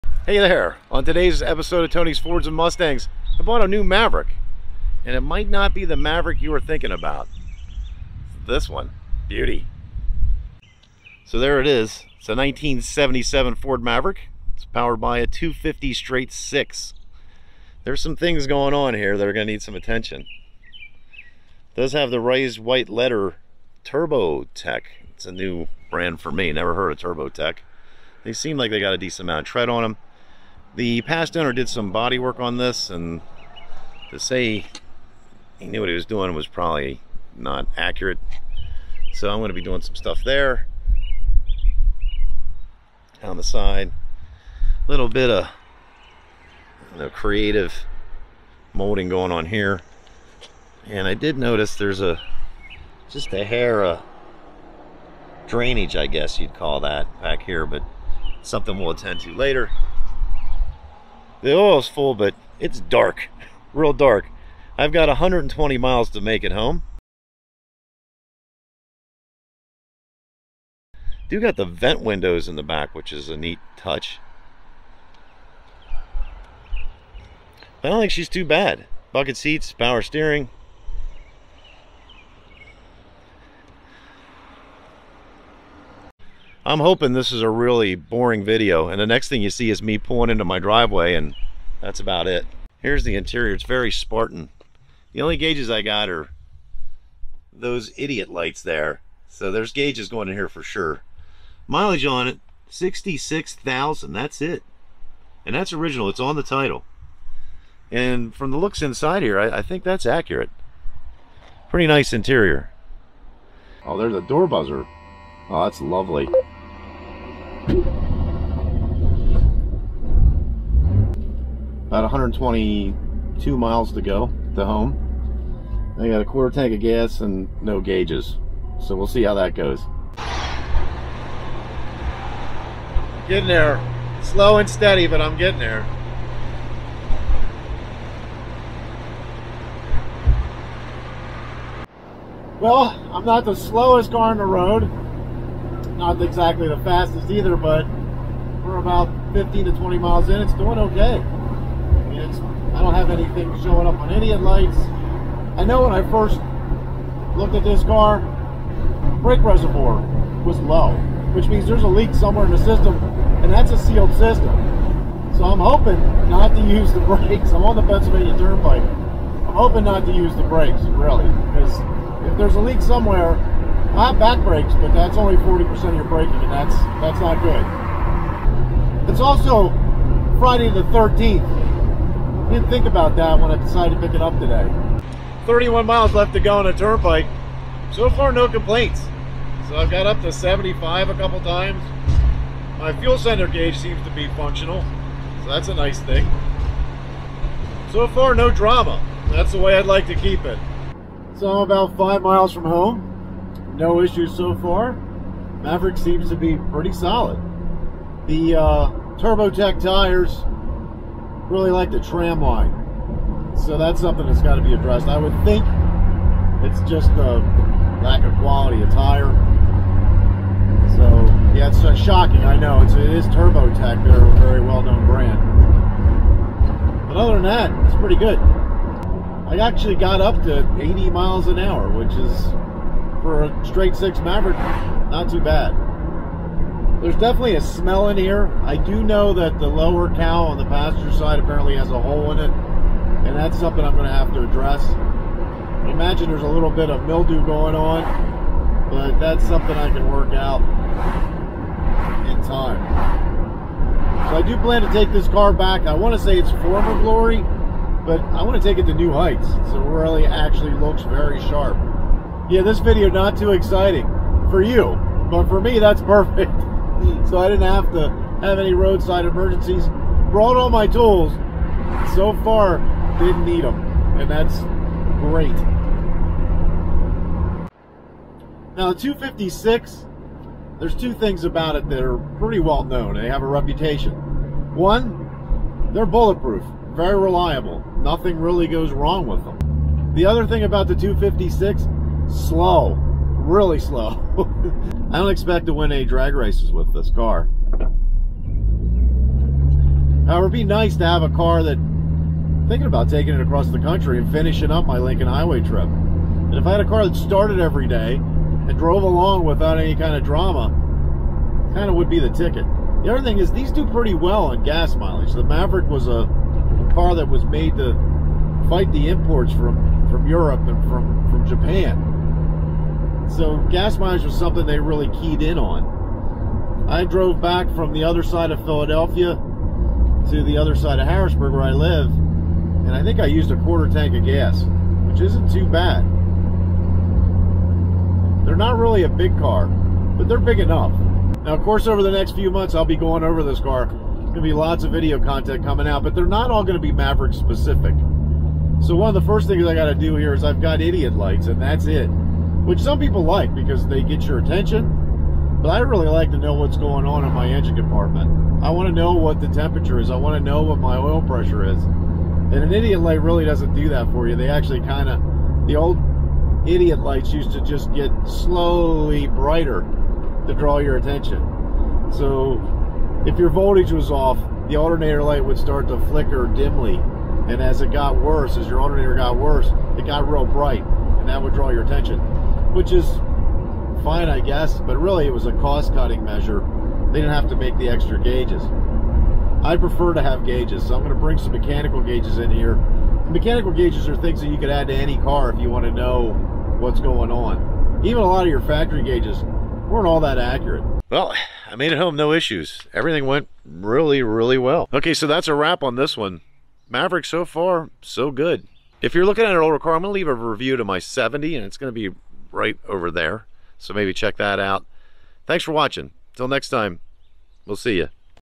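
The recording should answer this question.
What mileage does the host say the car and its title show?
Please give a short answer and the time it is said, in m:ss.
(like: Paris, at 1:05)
66,000, at 1:42.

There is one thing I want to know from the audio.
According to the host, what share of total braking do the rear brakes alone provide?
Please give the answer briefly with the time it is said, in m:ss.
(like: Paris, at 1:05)
40%, at 2:55.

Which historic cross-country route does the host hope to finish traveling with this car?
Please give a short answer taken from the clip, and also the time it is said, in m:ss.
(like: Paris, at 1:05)
Lincoln Highway, at 5:04.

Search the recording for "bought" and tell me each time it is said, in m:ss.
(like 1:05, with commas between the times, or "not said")
0:03.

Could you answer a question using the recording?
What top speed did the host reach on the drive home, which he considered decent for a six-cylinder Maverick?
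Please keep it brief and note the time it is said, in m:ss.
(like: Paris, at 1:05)
80 miles an hour, at 3:50.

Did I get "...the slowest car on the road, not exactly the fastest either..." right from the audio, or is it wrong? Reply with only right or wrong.
right.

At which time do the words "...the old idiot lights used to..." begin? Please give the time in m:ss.
6:05.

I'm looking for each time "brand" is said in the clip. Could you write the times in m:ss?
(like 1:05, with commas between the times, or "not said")
0:25, 3:45.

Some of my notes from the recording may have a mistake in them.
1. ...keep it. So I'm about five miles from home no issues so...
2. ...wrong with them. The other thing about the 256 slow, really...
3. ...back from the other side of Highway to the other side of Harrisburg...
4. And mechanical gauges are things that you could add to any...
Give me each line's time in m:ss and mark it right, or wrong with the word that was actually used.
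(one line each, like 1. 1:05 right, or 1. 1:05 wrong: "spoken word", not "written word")
1. 3:20 right
2. 4:48 right
3. 5:27 wrong: "Philadelphia", not "Highway"
4. 6:32 right.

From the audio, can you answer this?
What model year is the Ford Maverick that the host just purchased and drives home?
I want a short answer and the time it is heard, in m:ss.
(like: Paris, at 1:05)
1977, at 0:12.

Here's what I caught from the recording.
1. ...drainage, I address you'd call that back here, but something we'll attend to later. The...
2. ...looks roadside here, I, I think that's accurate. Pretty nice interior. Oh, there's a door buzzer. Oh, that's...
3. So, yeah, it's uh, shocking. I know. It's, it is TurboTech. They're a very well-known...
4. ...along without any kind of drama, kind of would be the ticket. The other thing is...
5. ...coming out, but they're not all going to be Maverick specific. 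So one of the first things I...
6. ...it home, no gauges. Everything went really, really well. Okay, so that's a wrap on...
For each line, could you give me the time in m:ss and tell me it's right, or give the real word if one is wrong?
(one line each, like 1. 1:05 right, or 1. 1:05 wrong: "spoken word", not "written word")
1. 0:55 wrong: "guess", not "address"
2. 1:48 wrong: "inside", not "roadside"
3. 3:40 right
4. 5:09 right
5. 5:45 right
6. 6:41 wrong: "issues", not "gauges".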